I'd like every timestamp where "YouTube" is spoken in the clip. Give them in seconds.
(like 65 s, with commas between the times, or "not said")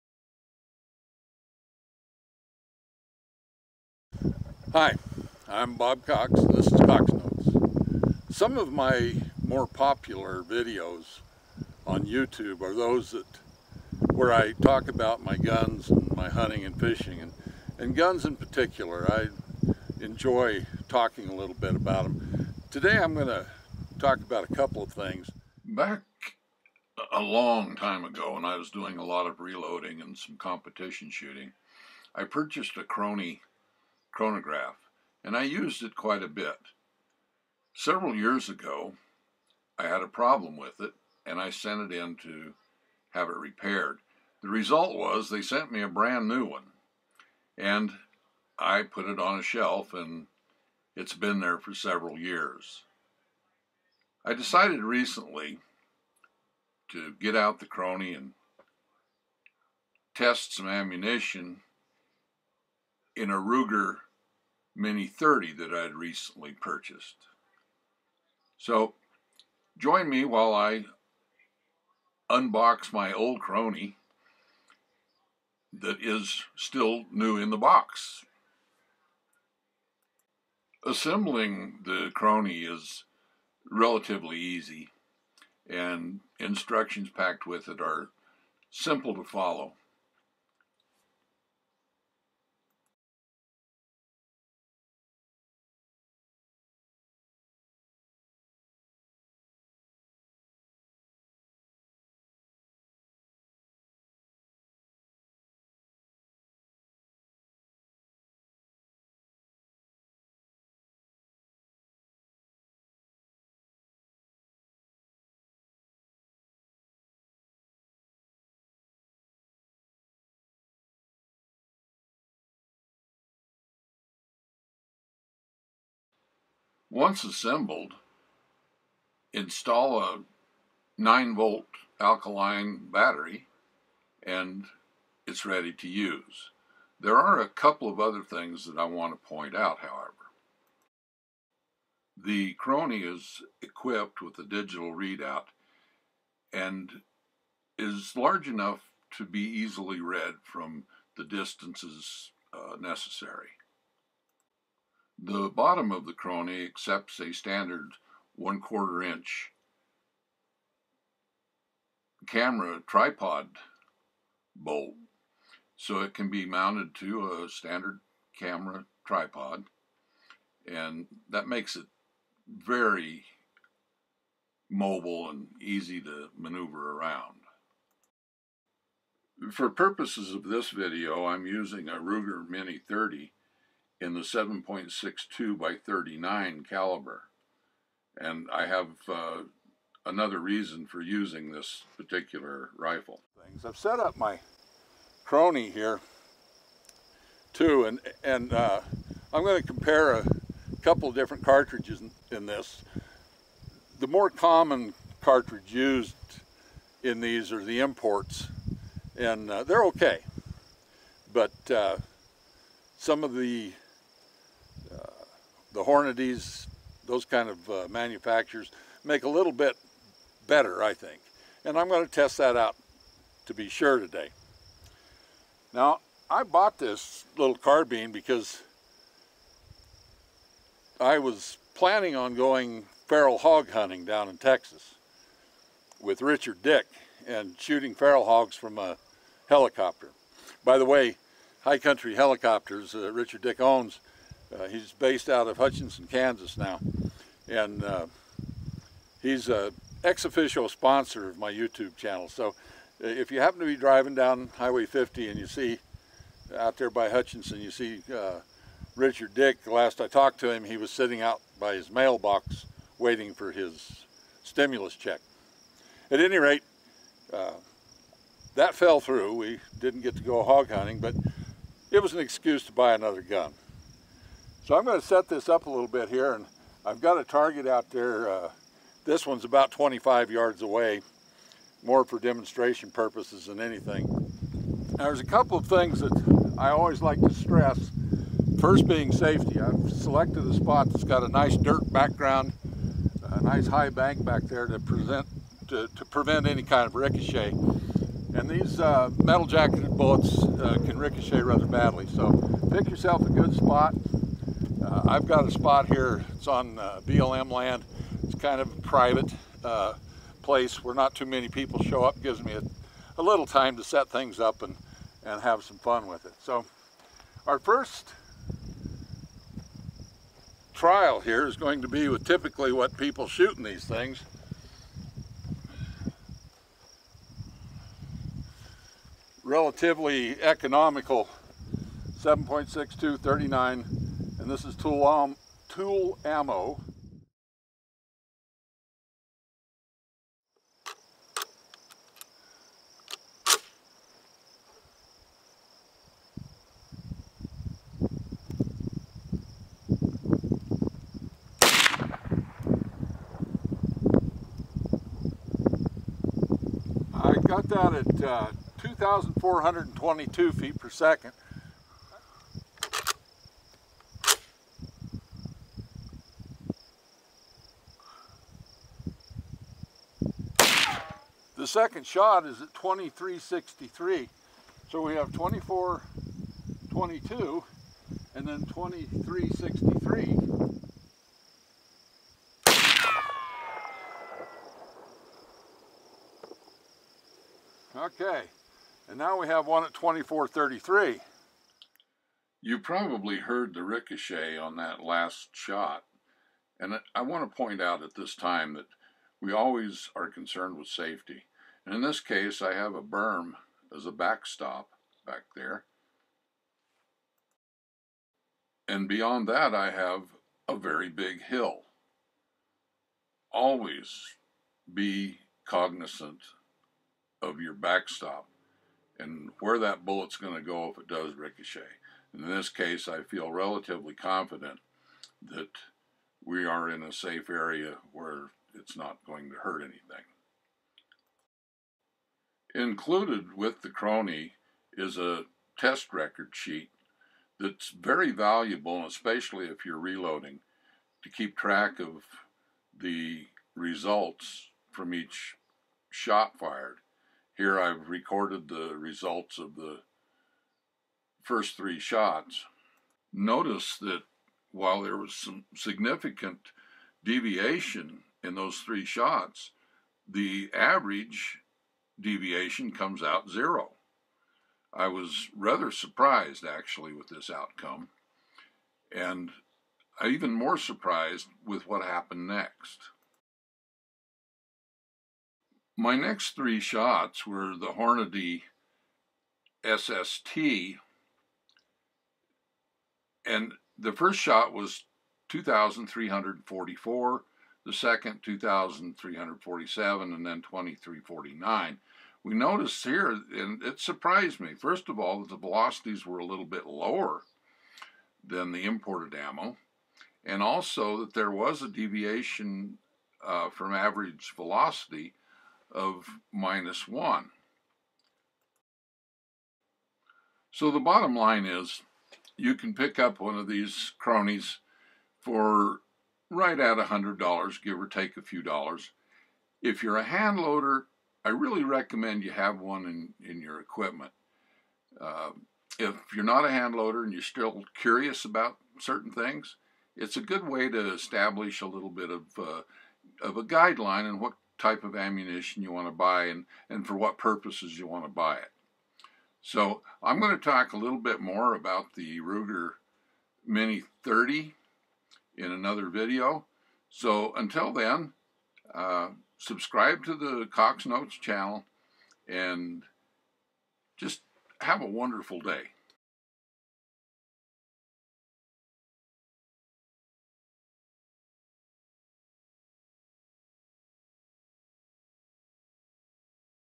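12 s, 251 s.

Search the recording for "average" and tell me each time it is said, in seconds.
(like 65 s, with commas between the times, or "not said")
460 s, 503 s.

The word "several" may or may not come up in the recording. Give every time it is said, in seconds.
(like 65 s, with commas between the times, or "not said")
37 s, 51 s.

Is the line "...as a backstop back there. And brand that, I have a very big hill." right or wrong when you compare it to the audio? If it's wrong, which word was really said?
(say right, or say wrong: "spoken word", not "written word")
wrong: "beyond", not "brand".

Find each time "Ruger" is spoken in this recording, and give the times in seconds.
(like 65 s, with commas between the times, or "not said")
63 s, 181 s, 542 s.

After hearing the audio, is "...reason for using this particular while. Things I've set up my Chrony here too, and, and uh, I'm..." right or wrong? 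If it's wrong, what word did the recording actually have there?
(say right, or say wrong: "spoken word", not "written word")
wrong: "rifle", not "while".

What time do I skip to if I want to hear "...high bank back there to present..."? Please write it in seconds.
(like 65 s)
293 s.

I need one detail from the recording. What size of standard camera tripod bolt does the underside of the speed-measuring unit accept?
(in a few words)
one quarter inch.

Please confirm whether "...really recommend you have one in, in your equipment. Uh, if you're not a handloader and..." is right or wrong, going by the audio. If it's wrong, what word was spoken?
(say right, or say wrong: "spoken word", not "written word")
right.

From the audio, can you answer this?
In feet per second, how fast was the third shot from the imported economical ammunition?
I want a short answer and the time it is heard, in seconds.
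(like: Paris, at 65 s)
2433, at 389 s.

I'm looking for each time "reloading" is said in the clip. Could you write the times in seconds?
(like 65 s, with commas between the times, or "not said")
29 s, 439 s.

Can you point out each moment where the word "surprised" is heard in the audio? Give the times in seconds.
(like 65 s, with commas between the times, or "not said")
465 s, 470 s, 493 s.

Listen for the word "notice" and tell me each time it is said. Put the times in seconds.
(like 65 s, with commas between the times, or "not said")
453 s, 492 s.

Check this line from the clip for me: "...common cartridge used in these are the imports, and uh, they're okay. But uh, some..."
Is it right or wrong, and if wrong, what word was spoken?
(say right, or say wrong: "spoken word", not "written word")
right.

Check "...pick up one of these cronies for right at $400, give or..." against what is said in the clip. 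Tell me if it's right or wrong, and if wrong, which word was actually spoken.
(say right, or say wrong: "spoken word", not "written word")
wrong: "100", not "400".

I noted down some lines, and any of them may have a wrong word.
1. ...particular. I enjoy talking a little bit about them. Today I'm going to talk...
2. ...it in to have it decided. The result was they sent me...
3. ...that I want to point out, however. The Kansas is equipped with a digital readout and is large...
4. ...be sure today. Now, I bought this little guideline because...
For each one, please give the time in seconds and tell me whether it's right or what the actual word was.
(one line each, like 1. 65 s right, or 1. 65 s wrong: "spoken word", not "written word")
1. 18 s right
2. 41 s wrong: "repaired", not "decided"
3. 138 s wrong: "Chrony", not "Kansas"
4. 223 s wrong: "carbine", not "guideline".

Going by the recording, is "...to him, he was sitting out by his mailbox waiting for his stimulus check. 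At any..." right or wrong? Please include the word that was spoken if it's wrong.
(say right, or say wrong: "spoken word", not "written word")
right.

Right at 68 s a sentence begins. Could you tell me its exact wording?
So join me while I unbox my old Chrony that is still new in the box.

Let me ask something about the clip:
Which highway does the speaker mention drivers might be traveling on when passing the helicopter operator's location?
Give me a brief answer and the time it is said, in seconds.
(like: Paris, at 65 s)
Highway 50, at 254 s.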